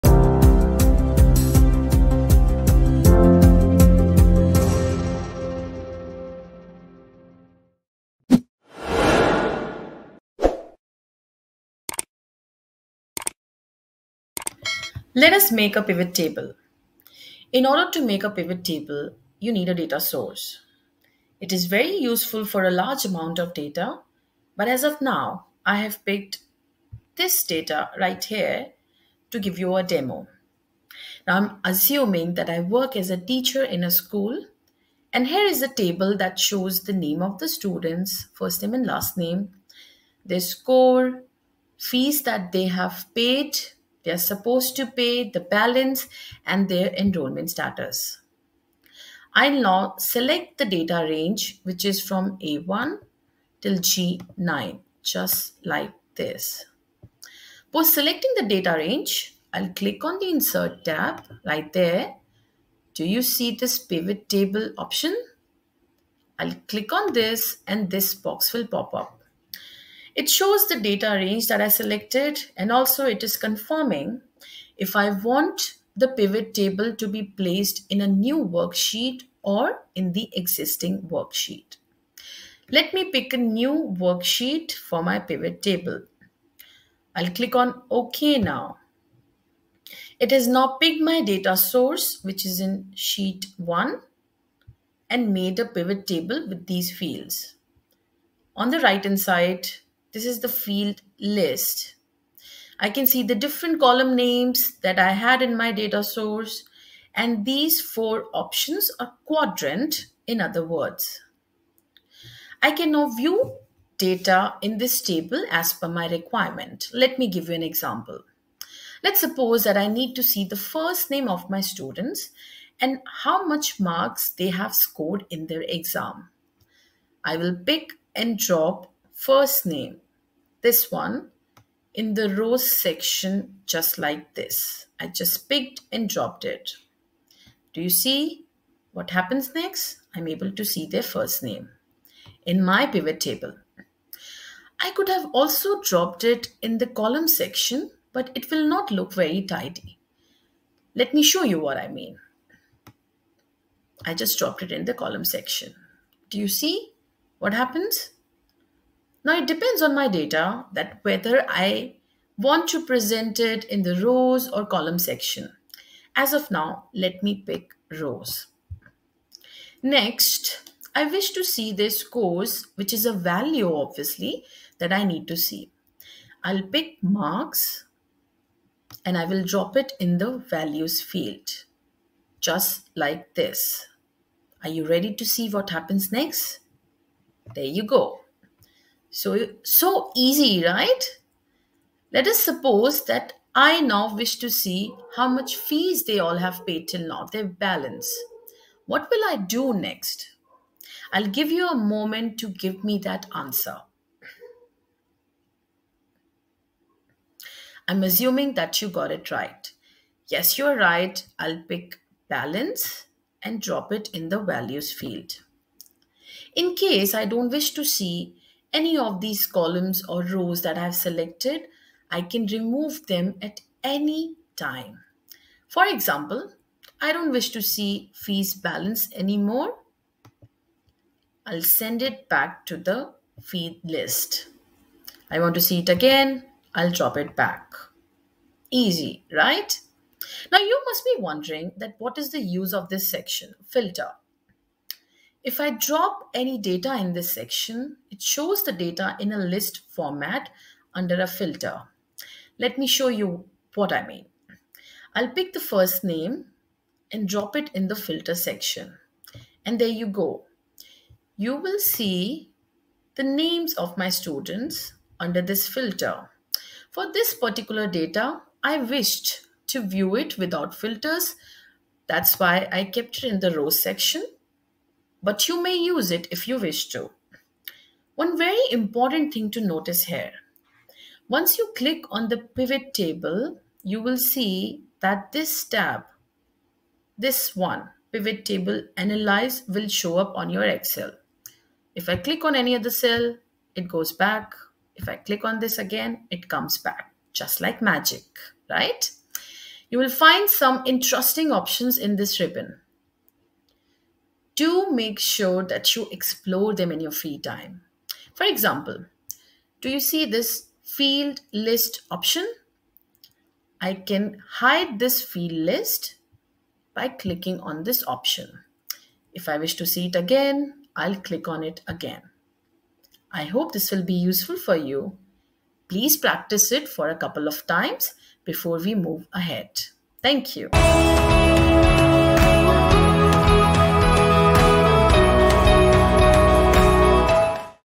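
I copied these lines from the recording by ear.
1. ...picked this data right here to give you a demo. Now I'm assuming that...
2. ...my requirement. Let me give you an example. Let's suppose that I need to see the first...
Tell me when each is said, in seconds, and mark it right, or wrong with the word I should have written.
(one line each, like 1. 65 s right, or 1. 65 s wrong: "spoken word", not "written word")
1. 26 s right
2. 115 s right.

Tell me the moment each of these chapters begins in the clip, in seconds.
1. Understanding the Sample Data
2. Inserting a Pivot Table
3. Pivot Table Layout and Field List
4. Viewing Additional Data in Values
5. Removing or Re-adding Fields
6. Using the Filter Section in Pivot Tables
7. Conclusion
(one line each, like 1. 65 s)
1. 29 s
2. 64 s
3. 99 s
4. 195 s
5. 225 s
6. 250 s
7. 325 s.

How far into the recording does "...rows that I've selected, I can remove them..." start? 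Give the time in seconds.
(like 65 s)
220 s.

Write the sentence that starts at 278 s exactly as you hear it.
One very important thing to notice here.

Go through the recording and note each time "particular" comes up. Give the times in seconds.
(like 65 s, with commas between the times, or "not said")
267 s.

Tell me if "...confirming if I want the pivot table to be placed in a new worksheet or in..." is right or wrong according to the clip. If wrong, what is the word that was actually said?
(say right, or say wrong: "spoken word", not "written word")
right.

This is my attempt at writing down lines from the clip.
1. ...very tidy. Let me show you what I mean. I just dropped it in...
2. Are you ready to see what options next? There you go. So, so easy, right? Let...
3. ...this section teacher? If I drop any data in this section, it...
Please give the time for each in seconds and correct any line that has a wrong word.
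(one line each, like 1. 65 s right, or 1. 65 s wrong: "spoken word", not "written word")
1. 149 s right
2. 184 s wrong: "happens", not "options"
3. 242 s wrong: "filter", not "teacher".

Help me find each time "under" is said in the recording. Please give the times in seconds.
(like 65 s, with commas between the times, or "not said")
250 s, 265 s.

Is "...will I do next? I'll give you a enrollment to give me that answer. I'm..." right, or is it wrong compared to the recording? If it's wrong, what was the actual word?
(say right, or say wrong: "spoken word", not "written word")
wrong: "moment", not "enrollment".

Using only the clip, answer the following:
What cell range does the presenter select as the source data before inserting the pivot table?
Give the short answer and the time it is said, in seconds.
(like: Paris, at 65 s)
A1 to G9, at 52 s.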